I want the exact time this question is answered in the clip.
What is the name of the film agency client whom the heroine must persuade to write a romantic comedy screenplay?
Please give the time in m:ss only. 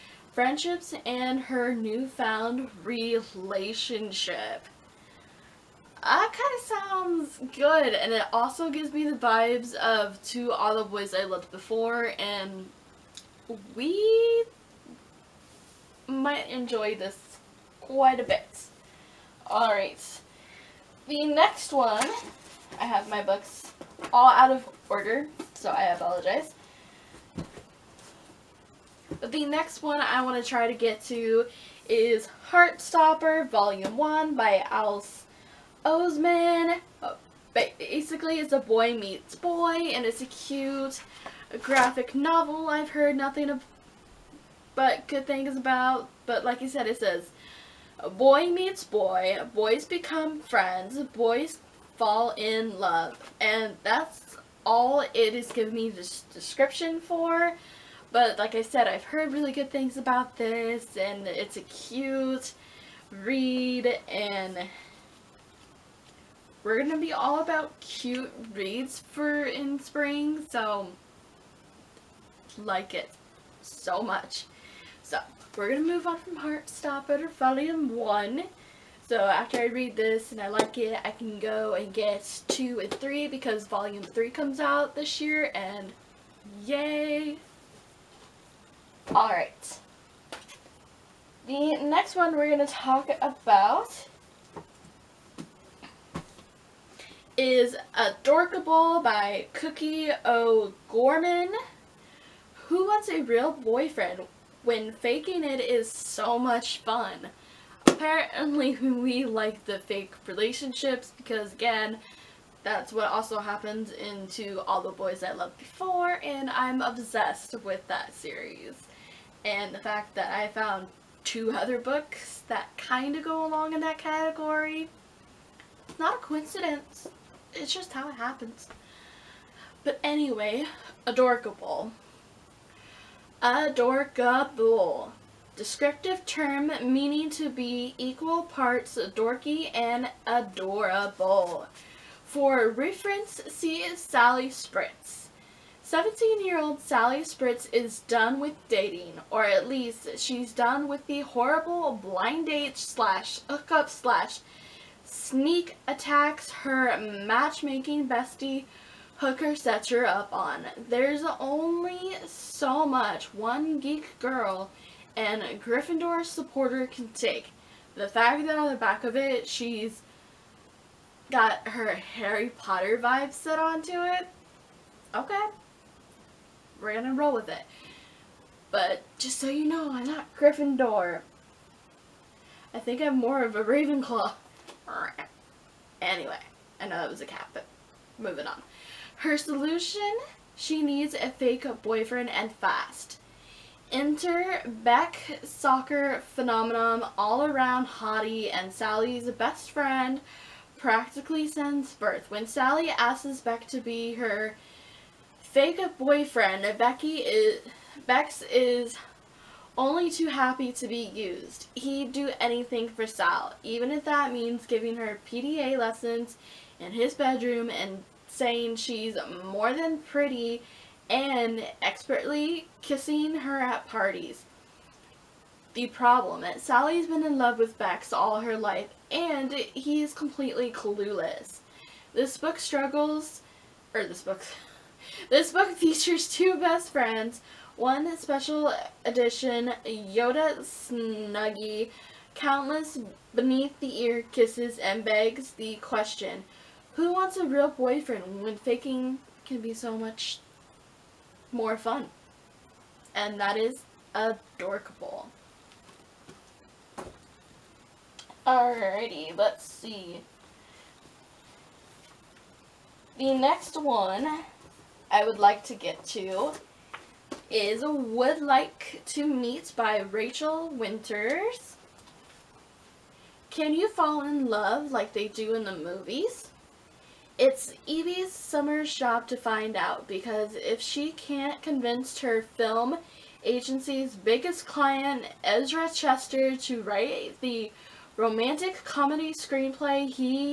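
4:45.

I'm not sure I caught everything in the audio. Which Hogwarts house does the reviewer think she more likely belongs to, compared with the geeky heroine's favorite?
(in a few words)
Ravenclaw.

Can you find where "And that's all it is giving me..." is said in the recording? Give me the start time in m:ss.
0:53.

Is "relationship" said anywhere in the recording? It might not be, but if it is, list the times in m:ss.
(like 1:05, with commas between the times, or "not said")
0:02, 1:50.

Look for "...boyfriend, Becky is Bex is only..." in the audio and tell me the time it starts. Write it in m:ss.
3:25.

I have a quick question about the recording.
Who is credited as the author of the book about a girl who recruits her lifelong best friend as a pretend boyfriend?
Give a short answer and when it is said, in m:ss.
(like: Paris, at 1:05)
Cookie O'Gorman, at 1:39.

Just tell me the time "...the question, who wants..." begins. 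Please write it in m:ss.
4:05.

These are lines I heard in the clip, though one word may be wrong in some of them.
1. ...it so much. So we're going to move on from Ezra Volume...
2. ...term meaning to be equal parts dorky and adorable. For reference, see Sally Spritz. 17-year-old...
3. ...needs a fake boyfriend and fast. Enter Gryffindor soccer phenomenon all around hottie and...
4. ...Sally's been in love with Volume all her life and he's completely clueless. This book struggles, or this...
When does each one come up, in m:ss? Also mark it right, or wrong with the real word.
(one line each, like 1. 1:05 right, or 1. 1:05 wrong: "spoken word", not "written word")
1. 1:12 wrong: "Heartstopper", not "Ezra"
2. 2:16 right
3. 3:10 wrong: "Beck", not "Gryffindor"
4. 3:46 wrong: "Bex", not "Volume".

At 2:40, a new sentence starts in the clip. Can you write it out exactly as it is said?
There's only so much one geek girl and Gryffindor supporter can take.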